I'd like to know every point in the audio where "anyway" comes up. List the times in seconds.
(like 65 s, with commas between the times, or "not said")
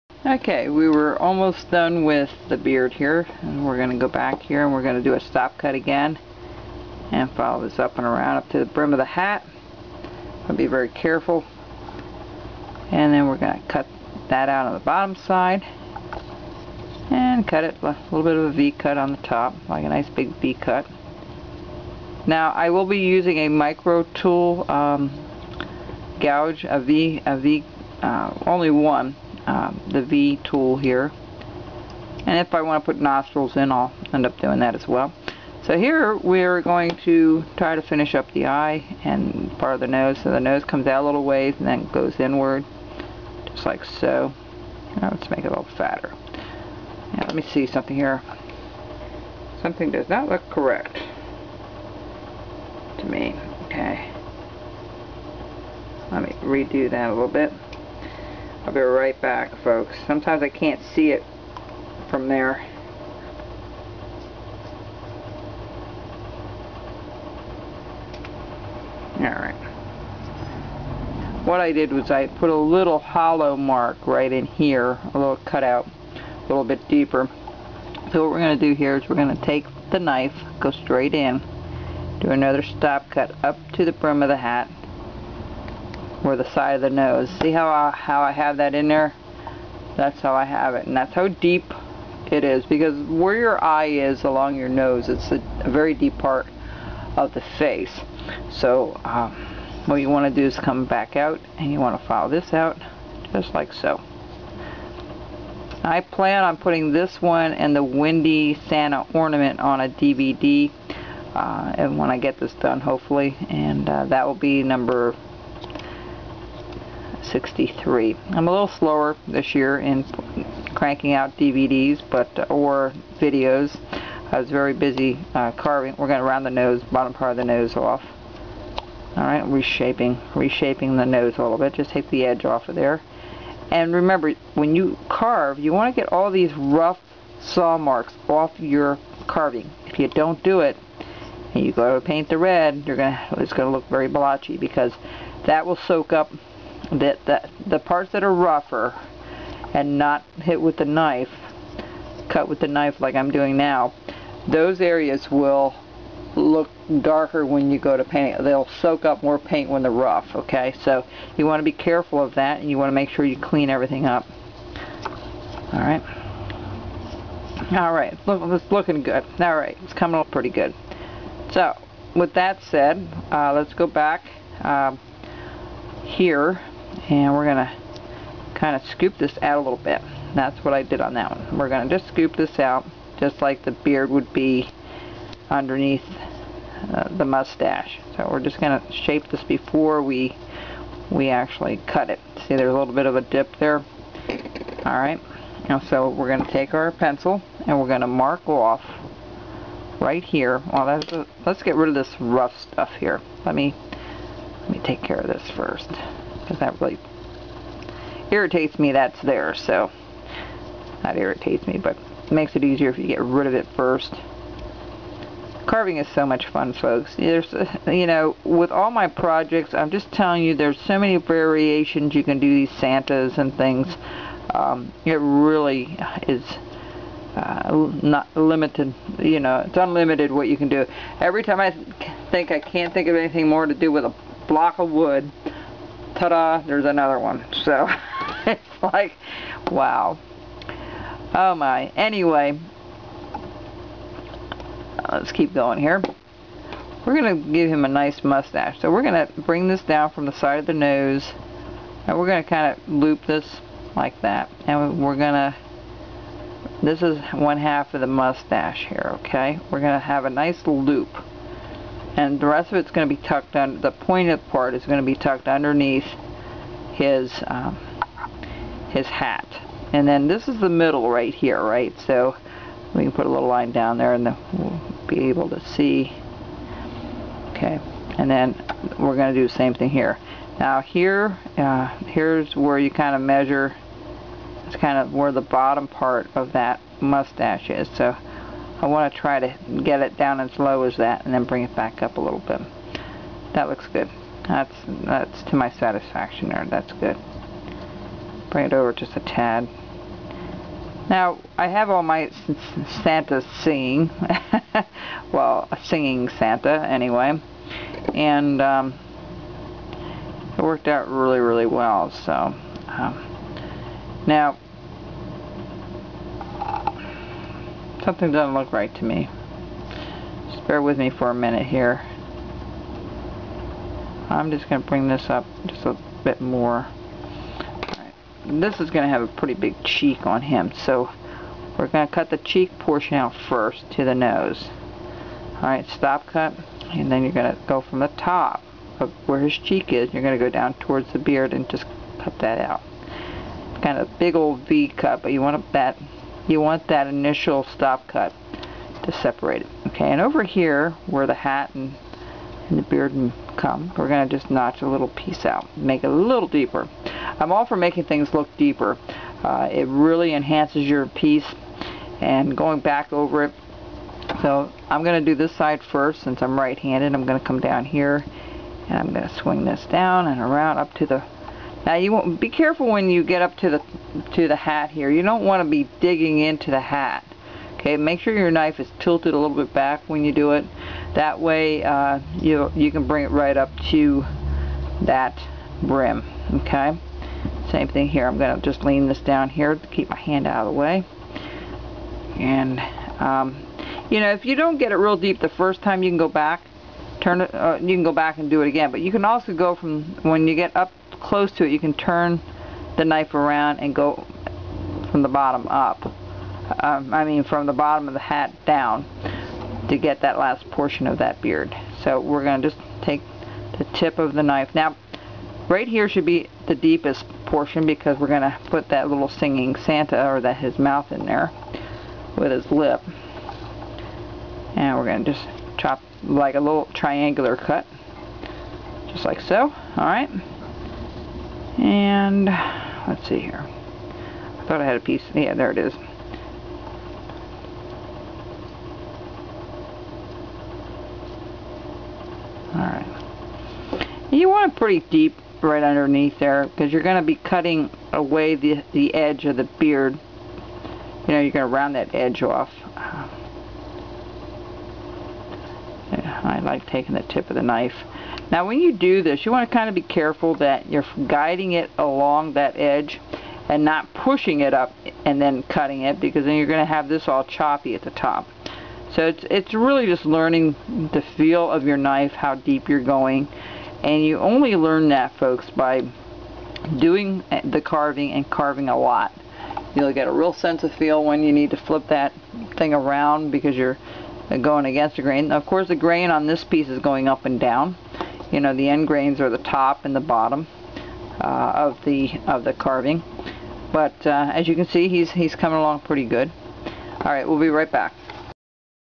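241 s, 306 s.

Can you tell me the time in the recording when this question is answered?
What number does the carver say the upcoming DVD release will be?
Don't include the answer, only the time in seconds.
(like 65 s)
117 s.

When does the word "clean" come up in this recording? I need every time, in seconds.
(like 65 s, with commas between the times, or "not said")
163 s.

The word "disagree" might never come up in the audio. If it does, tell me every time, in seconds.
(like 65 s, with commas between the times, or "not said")
not said.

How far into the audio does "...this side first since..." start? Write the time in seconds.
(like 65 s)
365 s.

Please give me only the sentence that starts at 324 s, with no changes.
I'm just going to bring this up just a bit more.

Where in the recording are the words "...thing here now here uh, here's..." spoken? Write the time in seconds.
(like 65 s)
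279 s.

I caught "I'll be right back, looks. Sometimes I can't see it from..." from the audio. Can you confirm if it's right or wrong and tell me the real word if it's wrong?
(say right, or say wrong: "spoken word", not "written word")
wrong: "folks", not "looks".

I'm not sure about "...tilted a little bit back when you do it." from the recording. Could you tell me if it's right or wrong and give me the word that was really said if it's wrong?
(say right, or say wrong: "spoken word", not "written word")
right.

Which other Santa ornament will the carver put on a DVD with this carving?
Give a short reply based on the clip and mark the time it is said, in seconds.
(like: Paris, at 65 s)
Windy Santa, at 107 s.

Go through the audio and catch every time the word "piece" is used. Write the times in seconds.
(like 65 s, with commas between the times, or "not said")
355 s, 361 s, 434 s, 486 s.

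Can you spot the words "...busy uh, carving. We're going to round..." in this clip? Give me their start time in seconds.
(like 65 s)
124 s.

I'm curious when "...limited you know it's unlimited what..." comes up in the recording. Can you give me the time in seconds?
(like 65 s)
228 s.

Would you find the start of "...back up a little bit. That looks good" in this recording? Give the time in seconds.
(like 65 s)
291 s.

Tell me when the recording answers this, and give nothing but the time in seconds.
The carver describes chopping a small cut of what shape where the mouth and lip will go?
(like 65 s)
426 s.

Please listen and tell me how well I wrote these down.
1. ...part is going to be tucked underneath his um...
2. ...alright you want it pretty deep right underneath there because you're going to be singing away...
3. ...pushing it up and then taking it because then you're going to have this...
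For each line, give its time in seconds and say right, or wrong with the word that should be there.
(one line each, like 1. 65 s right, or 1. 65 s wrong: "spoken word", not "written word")
1. 264 s right
2. 442 s wrong: "cutting", not "singing"
3. 464 s wrong: "cutting", not "taking".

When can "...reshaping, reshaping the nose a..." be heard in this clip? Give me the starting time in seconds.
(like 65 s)
129 s.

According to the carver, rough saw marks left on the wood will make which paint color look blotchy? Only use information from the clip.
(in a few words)
red.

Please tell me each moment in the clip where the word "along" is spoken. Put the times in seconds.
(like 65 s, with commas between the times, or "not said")
94 s, 461 s, 495 s.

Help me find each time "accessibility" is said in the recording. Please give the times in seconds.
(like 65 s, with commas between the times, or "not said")
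not said.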